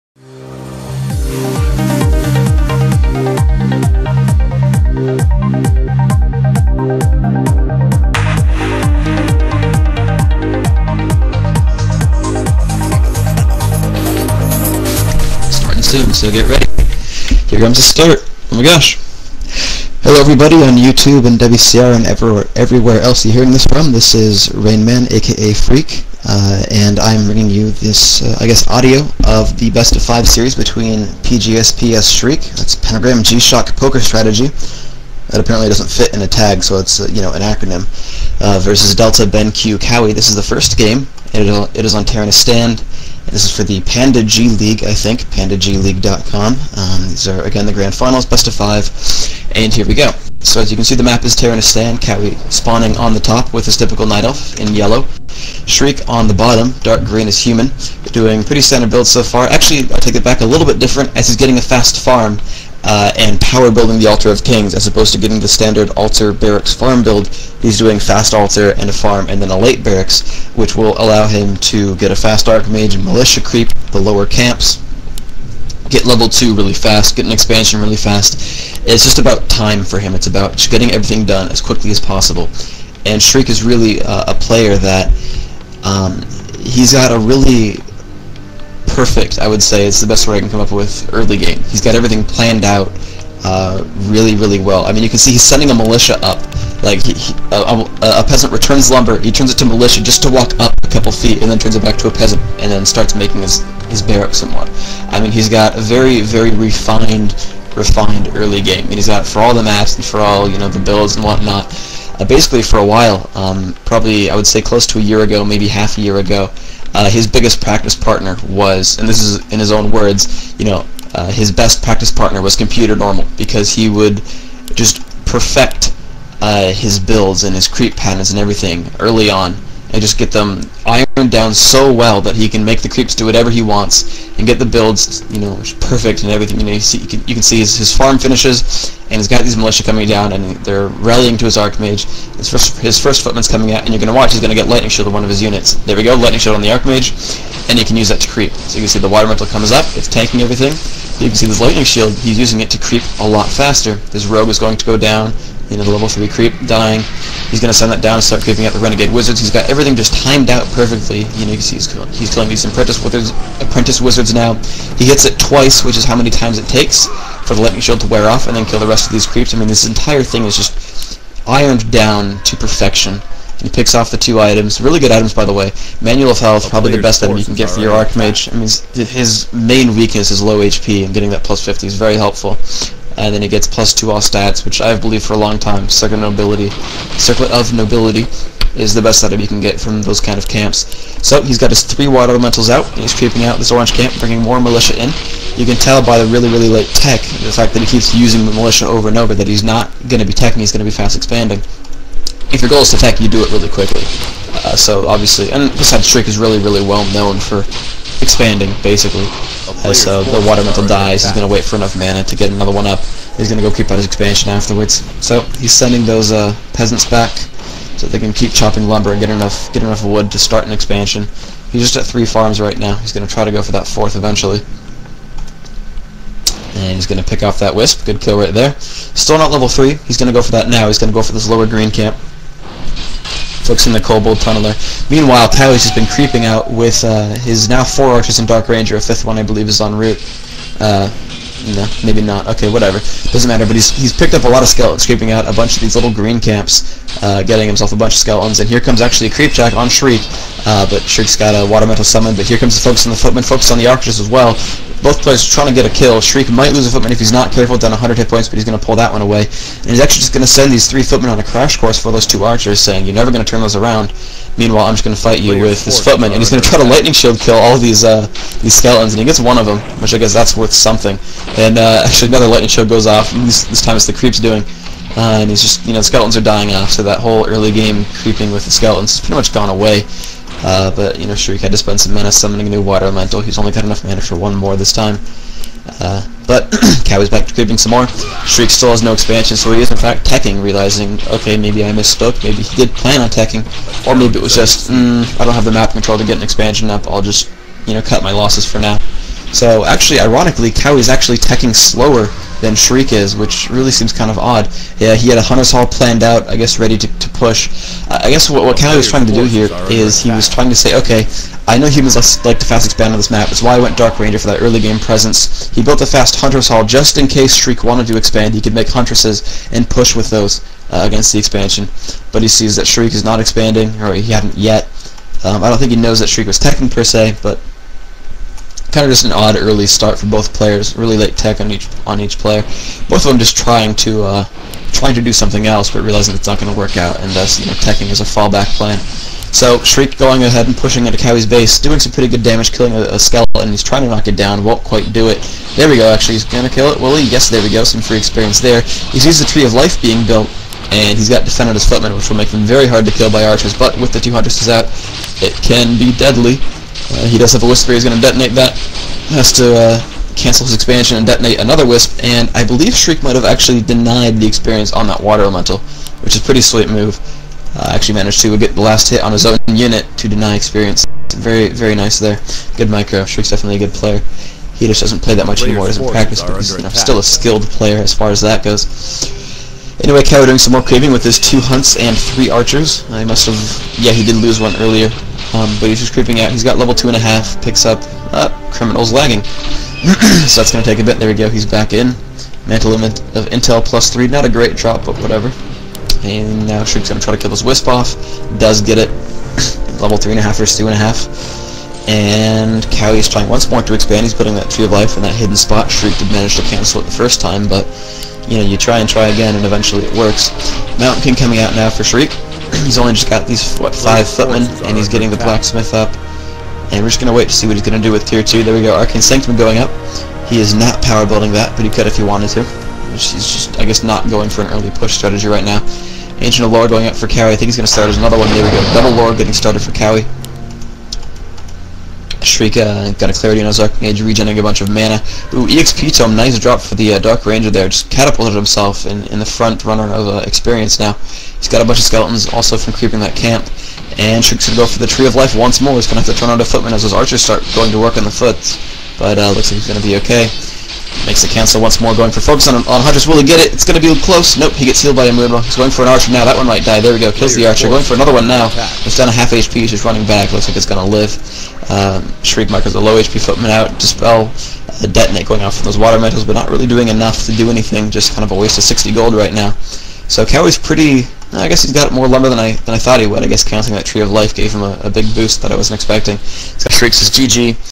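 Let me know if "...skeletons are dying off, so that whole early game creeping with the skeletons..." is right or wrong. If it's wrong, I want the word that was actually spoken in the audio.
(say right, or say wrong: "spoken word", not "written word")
right.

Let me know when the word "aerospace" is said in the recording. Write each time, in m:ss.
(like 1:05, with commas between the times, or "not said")
not said.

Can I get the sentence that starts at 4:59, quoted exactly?
So actually, ironically, Cowie's actually teching slower than Shriek is, which really seems kind of odd.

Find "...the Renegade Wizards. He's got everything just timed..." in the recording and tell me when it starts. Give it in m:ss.
2:38.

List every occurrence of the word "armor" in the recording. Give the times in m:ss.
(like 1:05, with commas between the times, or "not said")
not said.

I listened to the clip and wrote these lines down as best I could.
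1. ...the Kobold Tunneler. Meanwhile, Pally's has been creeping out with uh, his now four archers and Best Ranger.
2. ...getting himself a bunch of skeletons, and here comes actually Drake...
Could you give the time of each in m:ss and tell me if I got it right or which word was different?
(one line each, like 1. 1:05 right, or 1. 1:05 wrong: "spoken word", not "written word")
1. 3:53 wrong: "Dark", not "Best"
2. 4:07 wrong: "Creepjack", not "Drake".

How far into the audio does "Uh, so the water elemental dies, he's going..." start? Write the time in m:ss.
3:29.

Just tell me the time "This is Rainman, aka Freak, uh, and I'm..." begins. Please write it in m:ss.
0:23.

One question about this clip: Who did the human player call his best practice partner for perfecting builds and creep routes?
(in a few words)
computer normal.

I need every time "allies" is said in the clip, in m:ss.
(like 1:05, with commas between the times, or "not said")
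not said.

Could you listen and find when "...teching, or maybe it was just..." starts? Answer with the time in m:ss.
4:53.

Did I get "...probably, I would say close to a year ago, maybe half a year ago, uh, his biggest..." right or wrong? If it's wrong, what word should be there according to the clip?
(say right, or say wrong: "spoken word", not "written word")
right.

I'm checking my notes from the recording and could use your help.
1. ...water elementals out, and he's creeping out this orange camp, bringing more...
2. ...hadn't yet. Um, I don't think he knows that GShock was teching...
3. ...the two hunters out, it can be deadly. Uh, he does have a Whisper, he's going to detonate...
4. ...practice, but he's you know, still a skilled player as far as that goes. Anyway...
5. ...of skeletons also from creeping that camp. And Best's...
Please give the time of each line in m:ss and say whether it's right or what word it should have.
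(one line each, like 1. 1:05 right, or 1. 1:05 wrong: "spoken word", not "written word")
1. 3:12 right
2. 5:24 wrong: "Shriek", not "GShock"
3. 5:54 right
4. 6:16 right
5. 7:21 wrong: "Shriek", not "Best".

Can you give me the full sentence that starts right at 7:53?
I guess counting that Tree of Life gave him a, a big boost that I wasn't expecting.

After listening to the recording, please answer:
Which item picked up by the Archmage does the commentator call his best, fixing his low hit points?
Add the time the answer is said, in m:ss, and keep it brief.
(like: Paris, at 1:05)
Manual of Health, at 2:56.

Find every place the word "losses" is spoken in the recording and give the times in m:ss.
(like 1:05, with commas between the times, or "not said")
4:58.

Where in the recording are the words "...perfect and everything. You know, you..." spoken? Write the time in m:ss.
2:15.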